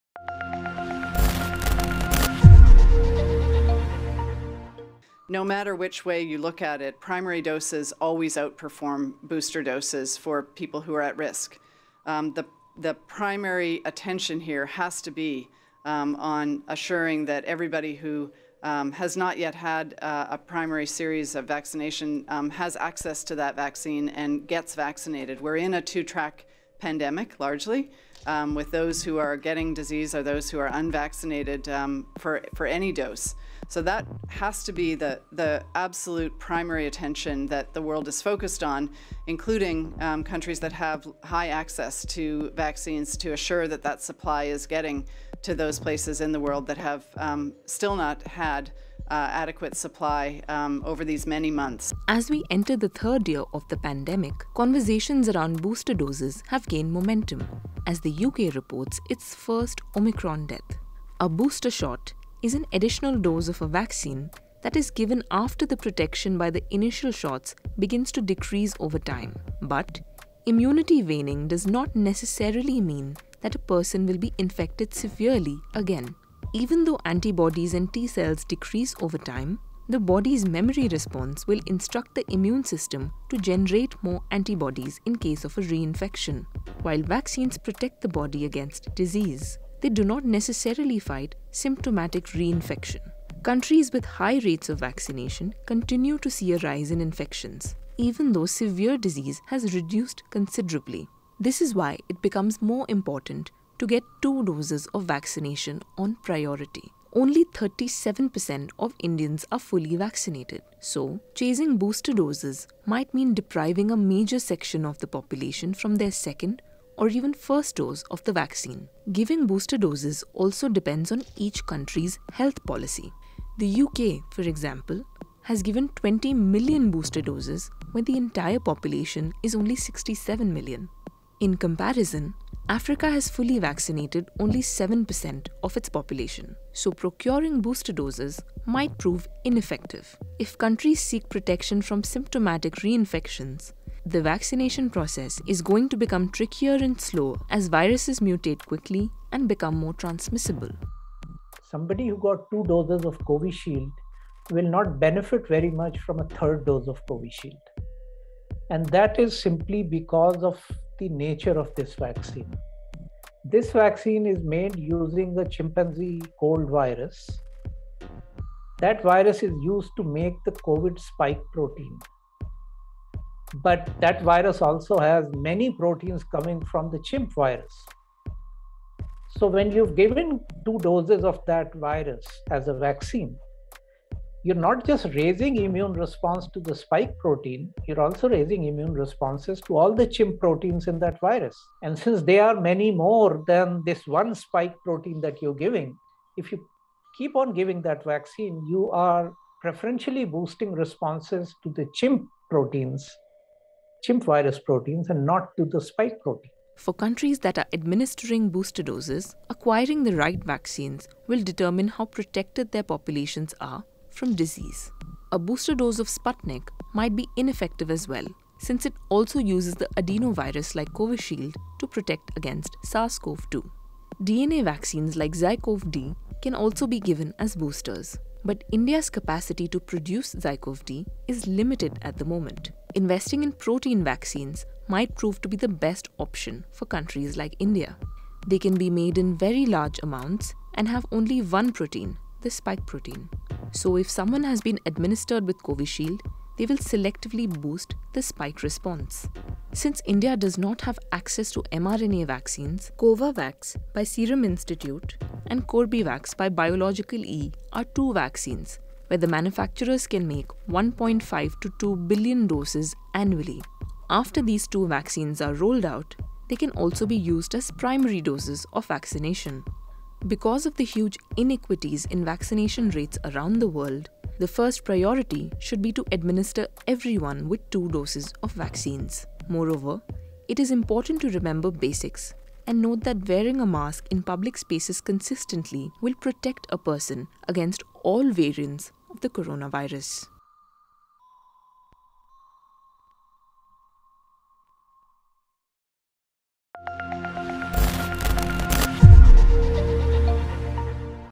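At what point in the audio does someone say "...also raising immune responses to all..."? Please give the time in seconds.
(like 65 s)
188 s.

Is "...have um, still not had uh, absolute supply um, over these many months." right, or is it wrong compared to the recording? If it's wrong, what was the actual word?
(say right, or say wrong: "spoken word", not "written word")
wrong: "adequate", not "absolute".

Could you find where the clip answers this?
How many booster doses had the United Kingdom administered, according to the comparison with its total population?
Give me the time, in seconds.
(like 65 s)
125 s.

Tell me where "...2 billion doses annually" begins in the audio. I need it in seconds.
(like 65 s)
261 s.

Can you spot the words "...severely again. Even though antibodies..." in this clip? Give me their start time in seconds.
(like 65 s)
74 s.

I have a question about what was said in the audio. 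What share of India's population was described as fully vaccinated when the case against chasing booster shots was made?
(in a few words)
37%.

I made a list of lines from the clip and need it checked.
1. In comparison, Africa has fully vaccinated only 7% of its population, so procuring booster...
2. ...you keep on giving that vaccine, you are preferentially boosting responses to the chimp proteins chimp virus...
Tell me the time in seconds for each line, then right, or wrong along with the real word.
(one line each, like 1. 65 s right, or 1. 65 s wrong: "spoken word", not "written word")
1. 131 s right
2. 196 s right.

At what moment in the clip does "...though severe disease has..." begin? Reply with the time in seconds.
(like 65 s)
98 s.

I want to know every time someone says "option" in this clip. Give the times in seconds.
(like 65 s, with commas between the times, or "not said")
236 s.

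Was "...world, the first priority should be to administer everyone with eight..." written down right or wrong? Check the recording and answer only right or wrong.
wrong.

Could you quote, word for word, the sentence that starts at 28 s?
Um, with those who are getting disease or those who are unvaccinated um, for, for any dose.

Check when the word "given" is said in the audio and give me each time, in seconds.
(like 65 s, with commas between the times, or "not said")
64 s, 125 s, 179 s, 226 s.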